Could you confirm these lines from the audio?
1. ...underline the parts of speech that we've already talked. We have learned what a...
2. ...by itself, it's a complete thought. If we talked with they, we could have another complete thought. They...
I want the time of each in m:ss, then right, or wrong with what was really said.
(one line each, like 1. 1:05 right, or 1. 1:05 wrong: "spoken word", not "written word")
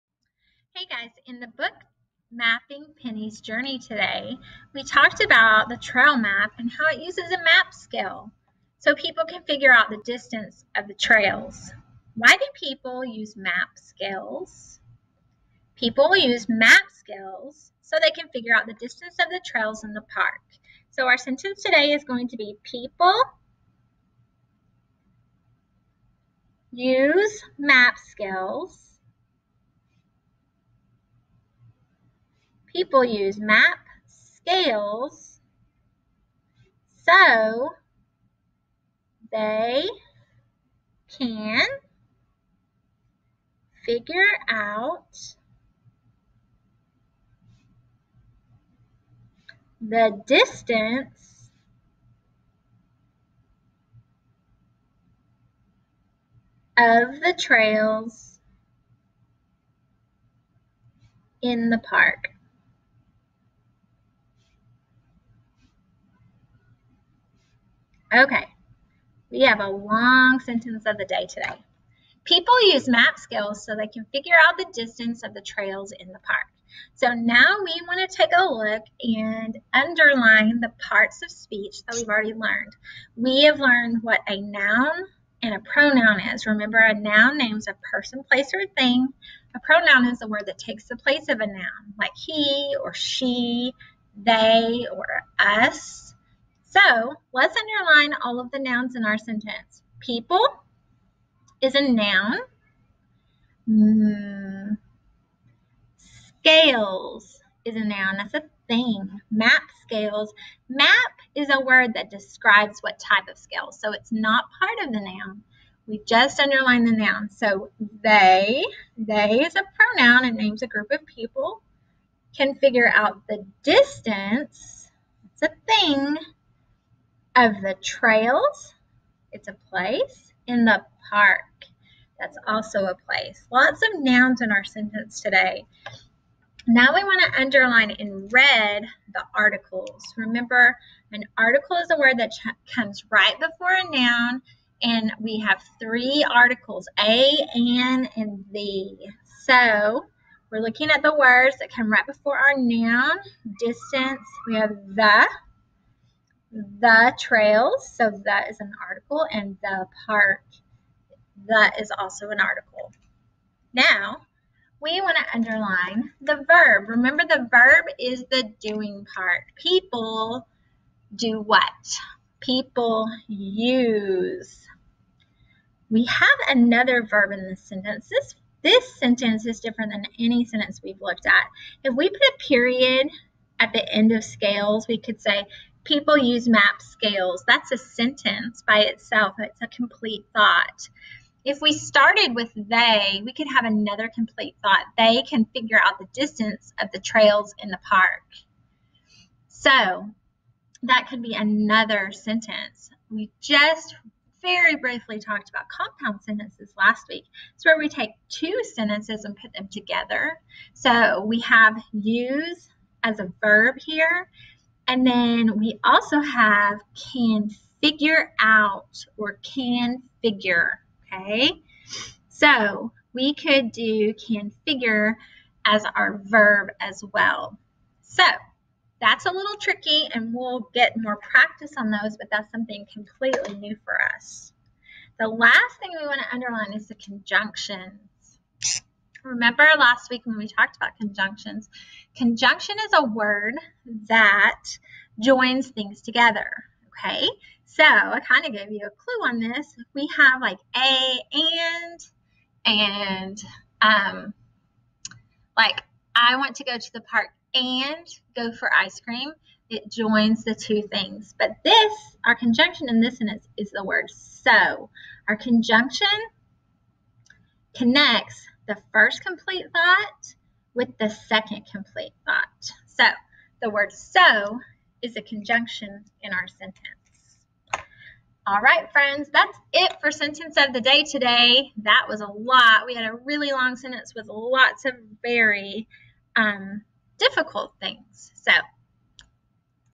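1. 1:19 wrong: "learned", not "talked"
2. 3:08 wrong: "started", not "talked".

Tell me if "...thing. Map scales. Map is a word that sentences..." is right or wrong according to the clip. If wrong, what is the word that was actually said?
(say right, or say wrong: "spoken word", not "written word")
wrong: "describes", not "sentences".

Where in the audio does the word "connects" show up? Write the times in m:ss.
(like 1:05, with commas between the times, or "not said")
4:27.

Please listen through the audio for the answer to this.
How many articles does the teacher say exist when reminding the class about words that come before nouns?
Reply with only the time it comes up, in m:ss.
2:25.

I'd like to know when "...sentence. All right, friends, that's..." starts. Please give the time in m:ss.
4:36.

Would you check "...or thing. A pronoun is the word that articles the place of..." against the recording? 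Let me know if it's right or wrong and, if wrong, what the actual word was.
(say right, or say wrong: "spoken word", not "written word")
wrong: "takes", not "articles".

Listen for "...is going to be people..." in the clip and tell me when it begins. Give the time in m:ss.
0:21.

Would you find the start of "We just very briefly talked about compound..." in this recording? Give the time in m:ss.
3:23.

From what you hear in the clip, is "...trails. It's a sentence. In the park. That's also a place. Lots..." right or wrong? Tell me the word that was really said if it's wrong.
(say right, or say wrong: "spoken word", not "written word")
wrong: "place", not "sentence".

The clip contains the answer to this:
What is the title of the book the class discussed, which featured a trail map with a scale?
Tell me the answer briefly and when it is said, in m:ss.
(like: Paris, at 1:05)
Mapping Penny's Journey, at 0:02.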